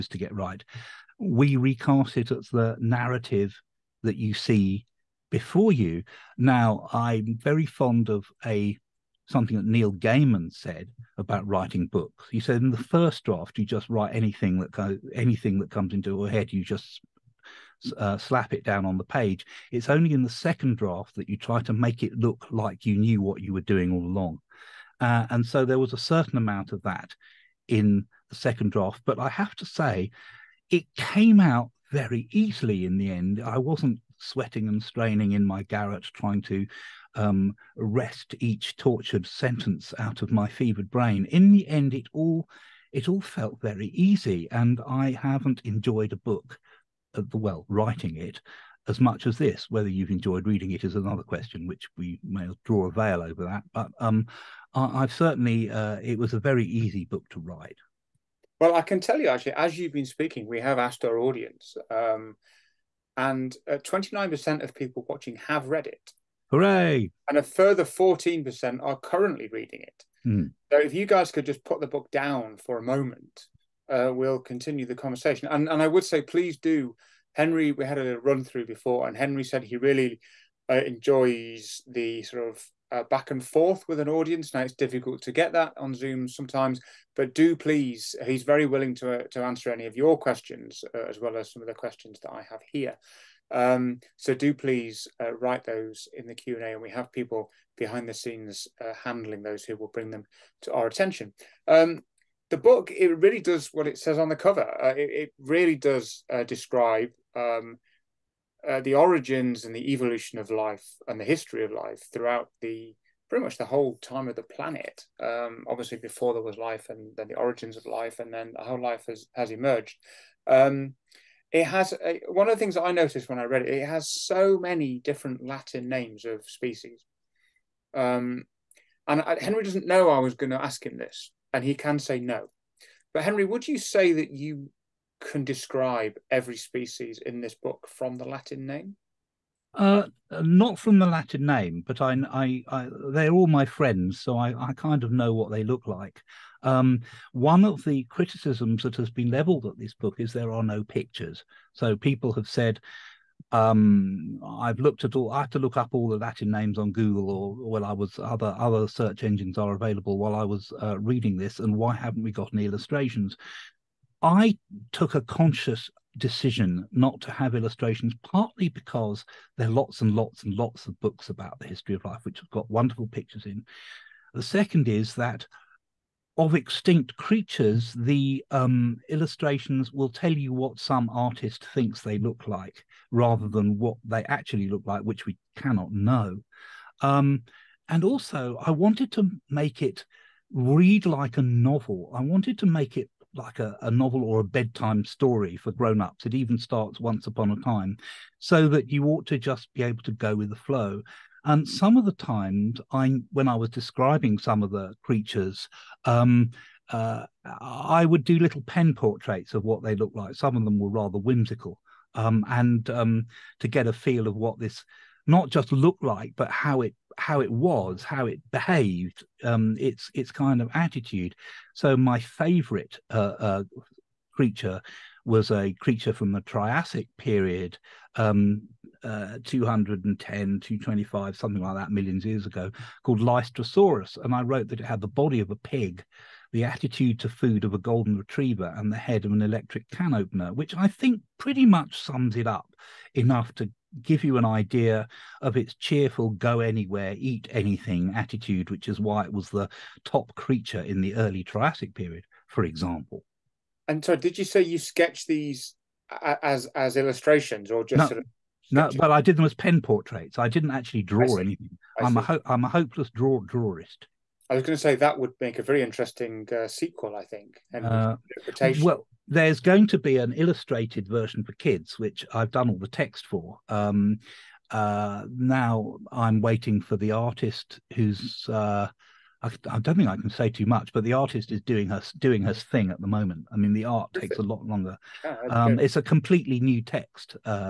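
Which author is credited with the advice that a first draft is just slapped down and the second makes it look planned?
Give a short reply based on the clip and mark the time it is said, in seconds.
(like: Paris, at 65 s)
Neil Gaiman, at 9 s.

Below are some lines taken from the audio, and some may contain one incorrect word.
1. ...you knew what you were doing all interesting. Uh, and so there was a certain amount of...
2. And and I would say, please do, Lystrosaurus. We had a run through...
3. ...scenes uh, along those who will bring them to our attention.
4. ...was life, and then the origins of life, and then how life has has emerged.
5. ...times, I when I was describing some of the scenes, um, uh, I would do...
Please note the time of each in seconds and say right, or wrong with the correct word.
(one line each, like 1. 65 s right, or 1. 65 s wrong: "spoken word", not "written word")
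1. 22 s wrong: "along", not "interesting"
2. 75 s wrong: "Henry", not "Lystrosaurus"
3. 98 s wrong: "handling", not "along"
4. 116 s right
5. 202 s wrong: "creatures", not "scenes".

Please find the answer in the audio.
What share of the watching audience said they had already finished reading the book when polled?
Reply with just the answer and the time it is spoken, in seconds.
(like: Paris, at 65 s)
29%, at 63 s.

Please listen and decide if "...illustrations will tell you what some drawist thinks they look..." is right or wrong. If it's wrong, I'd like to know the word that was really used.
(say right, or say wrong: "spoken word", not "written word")
wrong: "artist", not "drawist".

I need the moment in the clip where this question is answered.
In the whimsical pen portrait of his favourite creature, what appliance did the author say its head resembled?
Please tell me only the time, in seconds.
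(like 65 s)
239 s.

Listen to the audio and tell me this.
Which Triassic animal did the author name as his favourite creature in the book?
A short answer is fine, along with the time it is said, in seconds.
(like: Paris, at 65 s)
Lystrosaurus, at 233 s.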